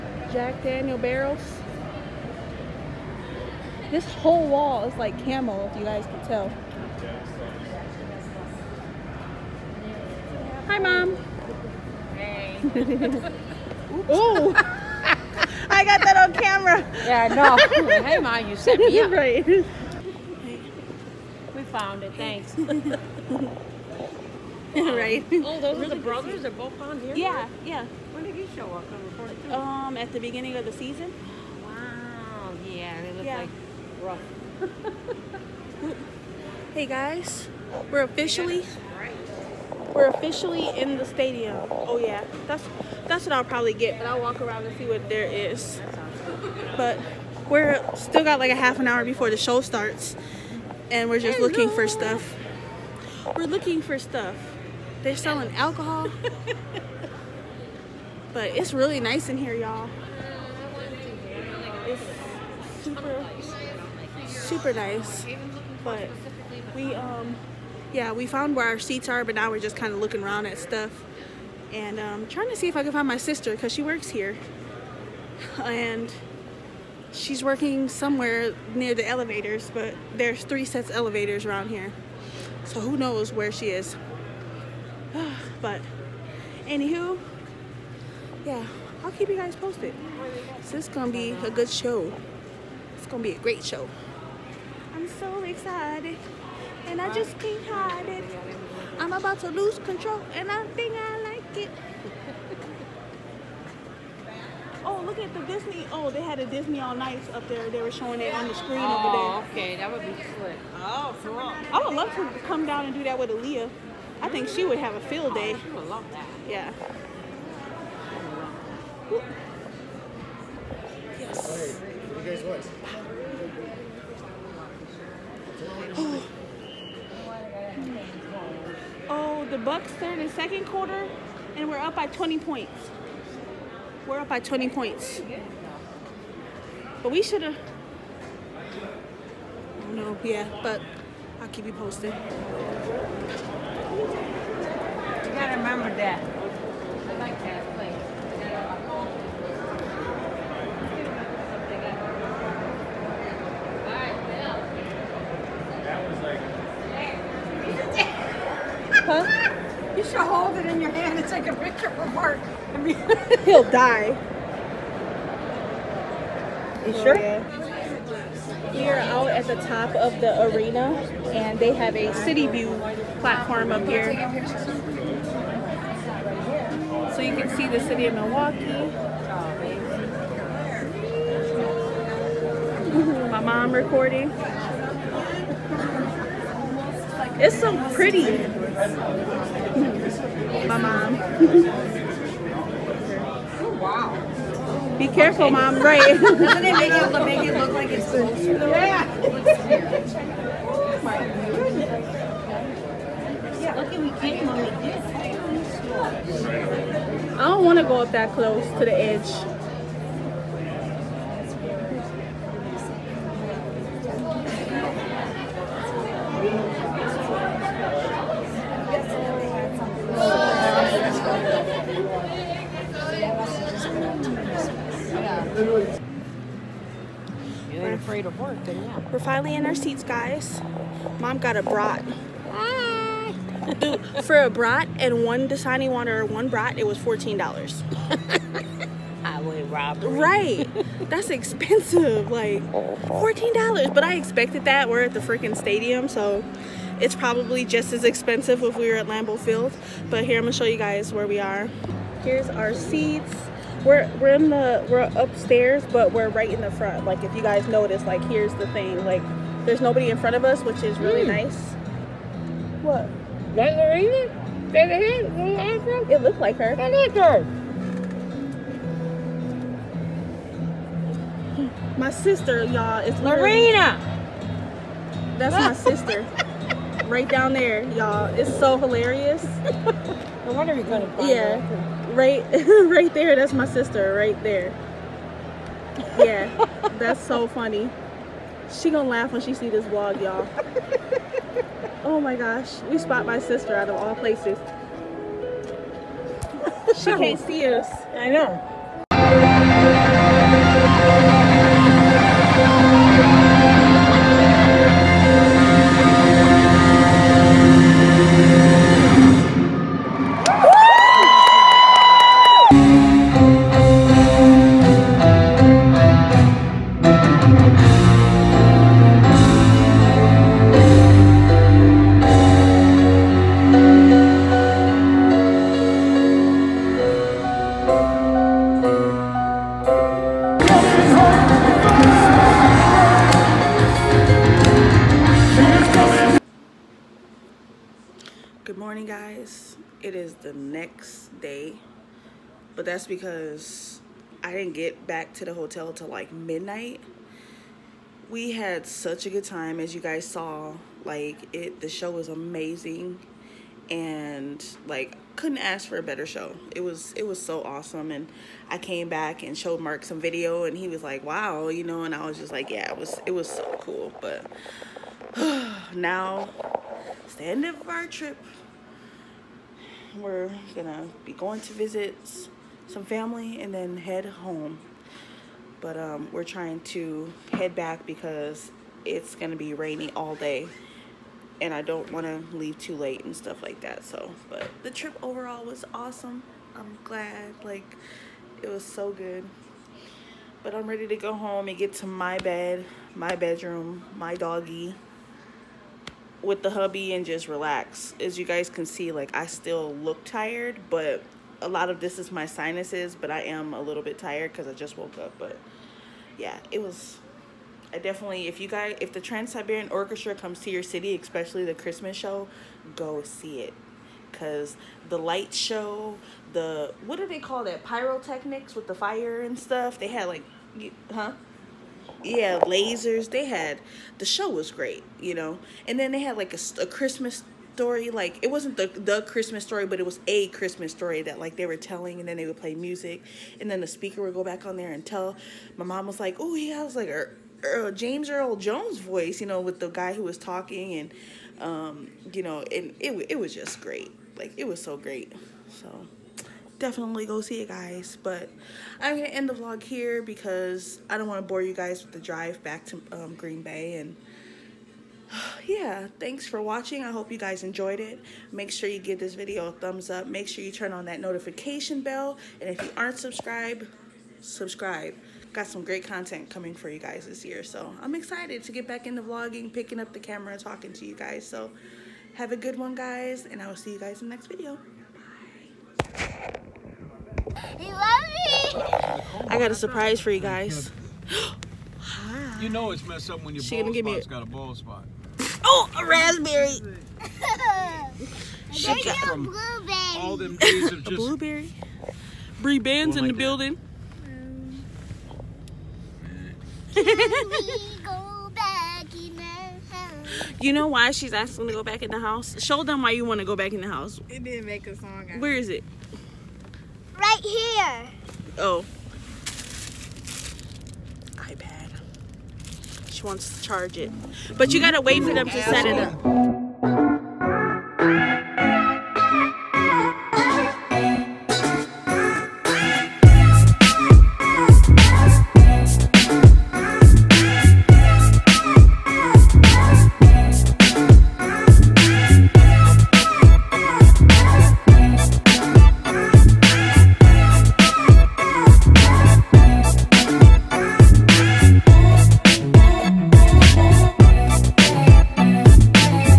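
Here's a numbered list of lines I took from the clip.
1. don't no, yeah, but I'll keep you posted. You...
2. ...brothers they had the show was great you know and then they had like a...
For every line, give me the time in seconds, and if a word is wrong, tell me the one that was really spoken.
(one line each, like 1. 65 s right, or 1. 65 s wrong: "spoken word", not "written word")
1. 139 s right
2. 422 s wrong: "lasers", not "brothers".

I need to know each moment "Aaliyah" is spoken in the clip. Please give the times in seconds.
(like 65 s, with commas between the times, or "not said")
113 s.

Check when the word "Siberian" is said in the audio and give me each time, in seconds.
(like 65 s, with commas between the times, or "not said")
409 s.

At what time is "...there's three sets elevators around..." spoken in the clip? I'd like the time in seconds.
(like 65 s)
80 s.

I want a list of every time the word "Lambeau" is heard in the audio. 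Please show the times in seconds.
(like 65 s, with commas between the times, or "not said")
249 s.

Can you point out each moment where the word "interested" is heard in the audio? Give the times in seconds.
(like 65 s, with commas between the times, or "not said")
not said.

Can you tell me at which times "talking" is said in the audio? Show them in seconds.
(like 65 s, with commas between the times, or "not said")
440 s, 470 s.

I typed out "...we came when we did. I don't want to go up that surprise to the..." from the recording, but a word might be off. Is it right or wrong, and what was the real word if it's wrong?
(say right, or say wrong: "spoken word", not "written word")
wrong: "close", not "surprise".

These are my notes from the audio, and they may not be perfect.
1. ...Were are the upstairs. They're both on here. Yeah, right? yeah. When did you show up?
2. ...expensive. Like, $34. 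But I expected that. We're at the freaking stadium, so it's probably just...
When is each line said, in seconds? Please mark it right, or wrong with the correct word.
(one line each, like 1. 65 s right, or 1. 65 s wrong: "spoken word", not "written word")
1. 25 s wrong: "brothers", not "upstairs"
2. 241 s wrong: "14", not "34".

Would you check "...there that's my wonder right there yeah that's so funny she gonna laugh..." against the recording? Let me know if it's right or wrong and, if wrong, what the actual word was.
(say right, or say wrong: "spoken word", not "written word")
wrong: "sister", not "wonder".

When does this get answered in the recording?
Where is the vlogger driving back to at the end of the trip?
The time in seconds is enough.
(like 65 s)
453 s.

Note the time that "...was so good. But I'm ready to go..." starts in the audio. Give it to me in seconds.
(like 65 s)
388 s.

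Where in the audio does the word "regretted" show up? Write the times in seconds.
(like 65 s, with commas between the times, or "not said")
not said.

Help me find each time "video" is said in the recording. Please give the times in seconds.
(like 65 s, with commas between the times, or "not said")
360 s, 459 s, 474 s.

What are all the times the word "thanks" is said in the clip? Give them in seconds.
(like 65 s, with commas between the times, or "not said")
22 s, 456 s.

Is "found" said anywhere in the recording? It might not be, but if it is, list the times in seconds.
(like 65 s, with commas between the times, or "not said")
21 s, 68 s.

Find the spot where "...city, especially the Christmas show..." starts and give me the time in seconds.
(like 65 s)
410 s.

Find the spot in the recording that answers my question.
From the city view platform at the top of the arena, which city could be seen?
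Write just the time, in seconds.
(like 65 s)
178 s.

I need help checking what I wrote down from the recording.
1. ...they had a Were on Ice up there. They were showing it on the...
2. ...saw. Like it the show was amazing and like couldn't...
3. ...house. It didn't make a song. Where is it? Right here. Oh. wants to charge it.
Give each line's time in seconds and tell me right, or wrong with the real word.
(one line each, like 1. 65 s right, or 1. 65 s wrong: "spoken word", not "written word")
1. 106 s wrong: "Disney", not "Were"
2. 350 s right
3. 503 s right.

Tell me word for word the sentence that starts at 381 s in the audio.
And I don't want to leave too late and stuff like that.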